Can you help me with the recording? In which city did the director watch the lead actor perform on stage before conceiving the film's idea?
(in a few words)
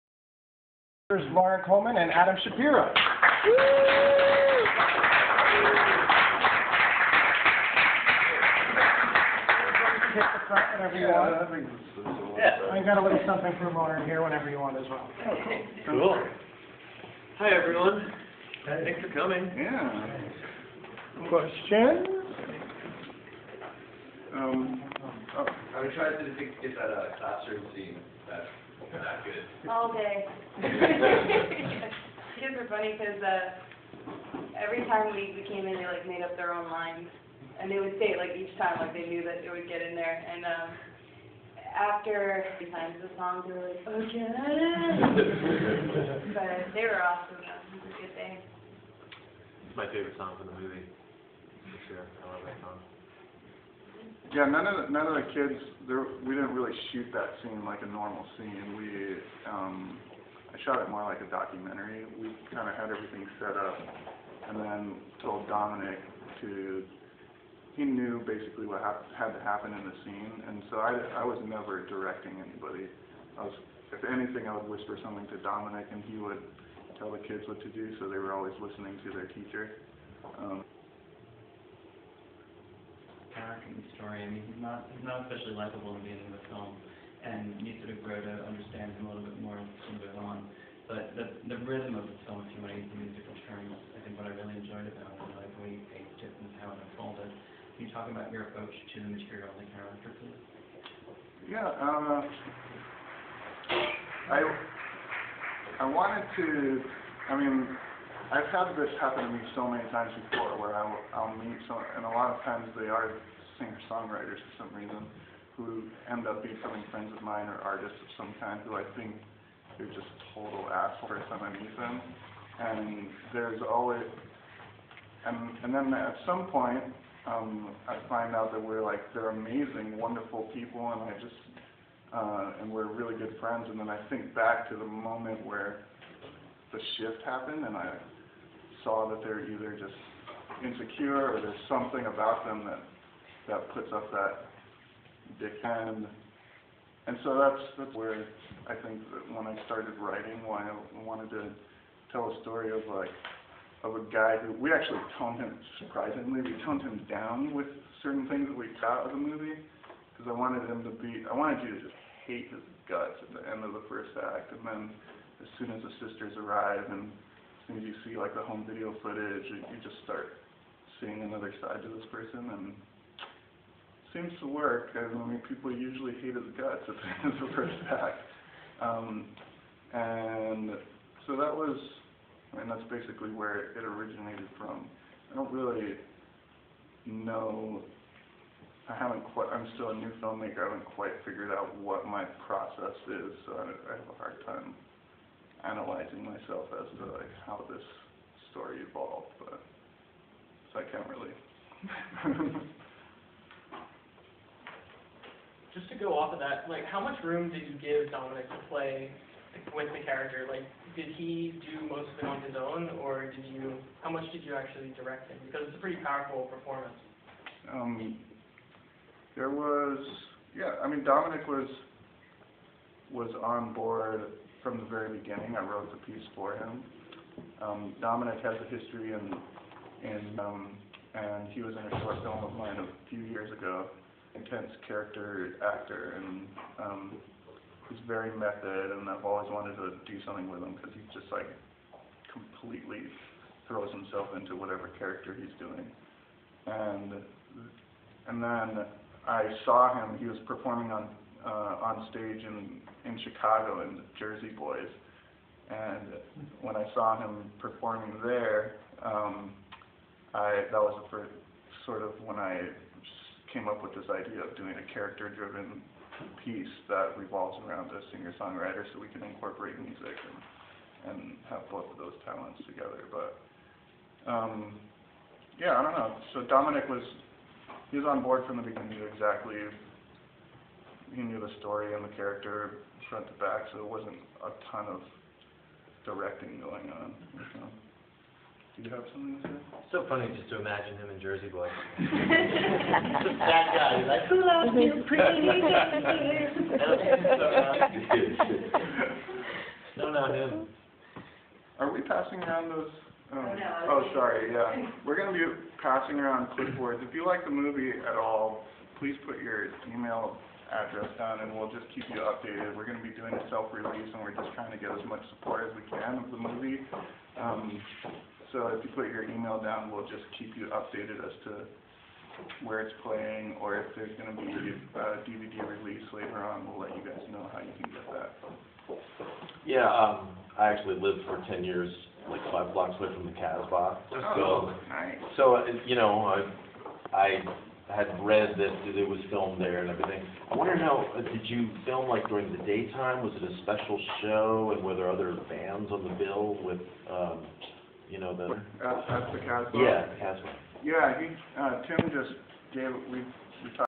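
Chicago.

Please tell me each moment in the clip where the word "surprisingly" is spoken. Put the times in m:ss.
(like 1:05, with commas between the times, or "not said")
2:35.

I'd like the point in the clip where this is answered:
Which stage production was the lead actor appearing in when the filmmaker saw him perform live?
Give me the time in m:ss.
4:13.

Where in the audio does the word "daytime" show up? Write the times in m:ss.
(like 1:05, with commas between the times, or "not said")
5:42.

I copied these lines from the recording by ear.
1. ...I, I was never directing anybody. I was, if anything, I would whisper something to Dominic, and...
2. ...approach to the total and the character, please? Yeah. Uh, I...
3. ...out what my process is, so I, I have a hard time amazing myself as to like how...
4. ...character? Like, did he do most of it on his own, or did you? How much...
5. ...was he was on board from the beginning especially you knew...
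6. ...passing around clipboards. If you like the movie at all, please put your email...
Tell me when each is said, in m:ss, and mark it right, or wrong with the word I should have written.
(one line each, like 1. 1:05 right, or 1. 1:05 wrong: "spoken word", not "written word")
1. 1:10 right
2. 1:38 wrong: "material", not "total"
3. 3:11 wrong: "analyzing", not "amazing"
4. 3:30 right
5. 4:36 wrong: "exactly", not "especially"
6. 5:05 right.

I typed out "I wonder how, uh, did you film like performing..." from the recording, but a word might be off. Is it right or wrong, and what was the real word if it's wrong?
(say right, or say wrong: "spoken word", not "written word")
wrong: "during", not "performing".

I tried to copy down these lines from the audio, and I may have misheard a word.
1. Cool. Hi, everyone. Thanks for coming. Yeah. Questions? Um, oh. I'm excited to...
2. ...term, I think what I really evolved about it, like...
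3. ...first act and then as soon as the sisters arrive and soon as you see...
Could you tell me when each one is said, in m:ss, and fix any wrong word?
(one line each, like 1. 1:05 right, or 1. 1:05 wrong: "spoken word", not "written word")
1. 0:15 right
2. 1:33 wrong: "enjoyed", not "evolved"
3. 2:43 right.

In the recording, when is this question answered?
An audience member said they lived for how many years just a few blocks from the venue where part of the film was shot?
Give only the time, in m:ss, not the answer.
5:31.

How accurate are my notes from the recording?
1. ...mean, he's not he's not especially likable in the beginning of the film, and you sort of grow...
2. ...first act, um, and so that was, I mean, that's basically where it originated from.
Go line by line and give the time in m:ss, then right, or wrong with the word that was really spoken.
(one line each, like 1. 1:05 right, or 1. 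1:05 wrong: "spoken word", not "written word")
1. 1:24 right
2. 2:57 right.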